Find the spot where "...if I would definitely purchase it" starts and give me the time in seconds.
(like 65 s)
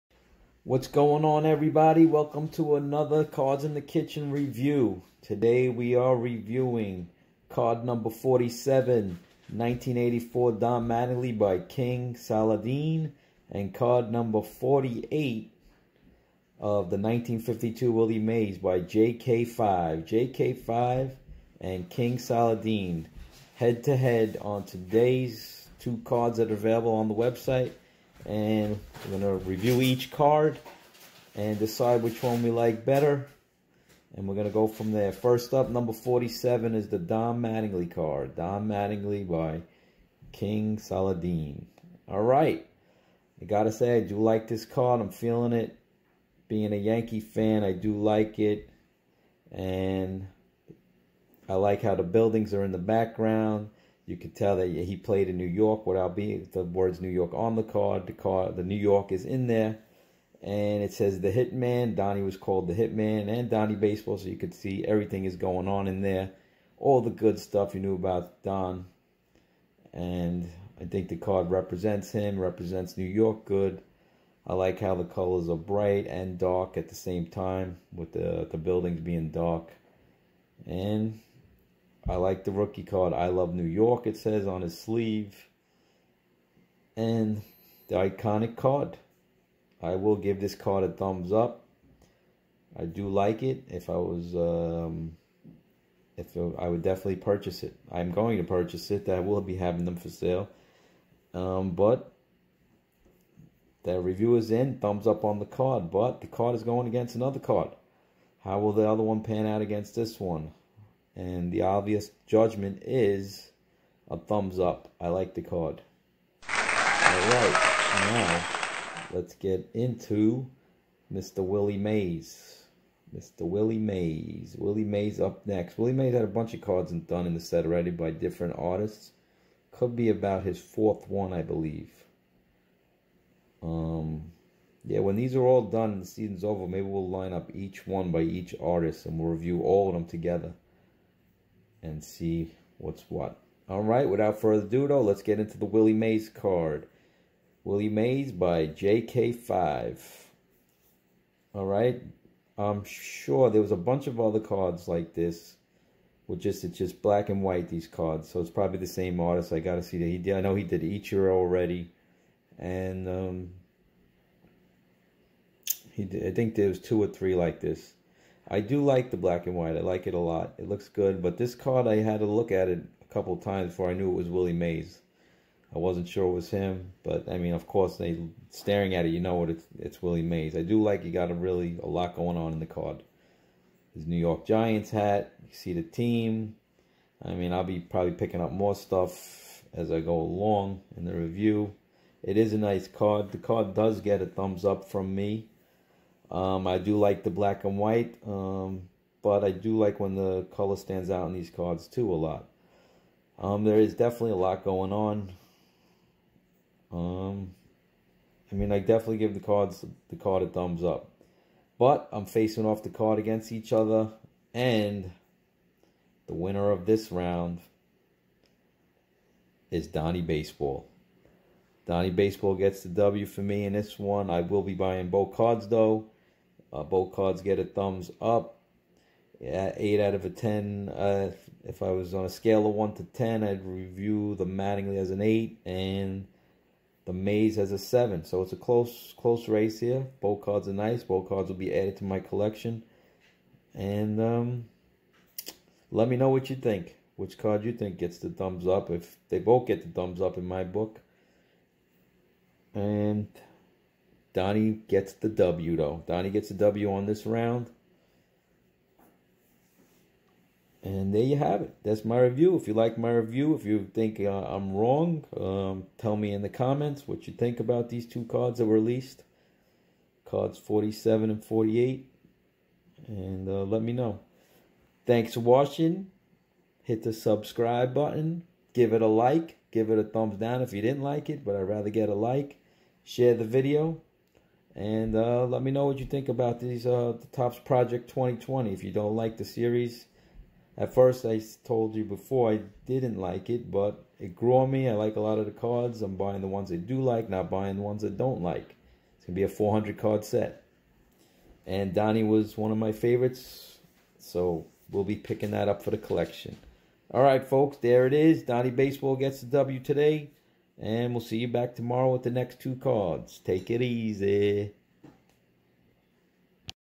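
96 s.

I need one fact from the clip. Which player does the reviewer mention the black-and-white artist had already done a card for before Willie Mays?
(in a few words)
Ichiro.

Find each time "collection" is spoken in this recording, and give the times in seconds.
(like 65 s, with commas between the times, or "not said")
242 s, 305 s.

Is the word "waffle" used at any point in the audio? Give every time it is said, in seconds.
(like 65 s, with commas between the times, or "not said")
not said.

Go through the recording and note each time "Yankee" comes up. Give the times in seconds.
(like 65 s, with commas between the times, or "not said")
46 s.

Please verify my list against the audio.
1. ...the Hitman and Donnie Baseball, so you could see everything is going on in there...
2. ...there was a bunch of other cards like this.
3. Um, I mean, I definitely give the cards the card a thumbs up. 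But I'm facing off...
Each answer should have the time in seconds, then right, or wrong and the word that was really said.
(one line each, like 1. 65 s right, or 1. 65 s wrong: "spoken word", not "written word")
1. 62 s right
2. 153 s right
3. 206 s right.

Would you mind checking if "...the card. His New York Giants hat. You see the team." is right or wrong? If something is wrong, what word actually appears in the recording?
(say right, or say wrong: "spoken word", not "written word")
right.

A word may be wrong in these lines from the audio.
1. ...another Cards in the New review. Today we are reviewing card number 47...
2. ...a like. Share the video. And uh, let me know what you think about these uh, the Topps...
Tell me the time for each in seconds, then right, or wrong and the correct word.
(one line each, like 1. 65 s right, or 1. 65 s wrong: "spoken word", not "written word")
1. 2 s wrong: "Kitchen", not "New"
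2. 282 s right.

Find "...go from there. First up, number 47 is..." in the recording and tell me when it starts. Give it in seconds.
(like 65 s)
34 s.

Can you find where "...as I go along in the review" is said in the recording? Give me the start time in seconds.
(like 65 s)
189 s.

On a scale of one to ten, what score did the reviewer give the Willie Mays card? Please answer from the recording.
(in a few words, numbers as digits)
7.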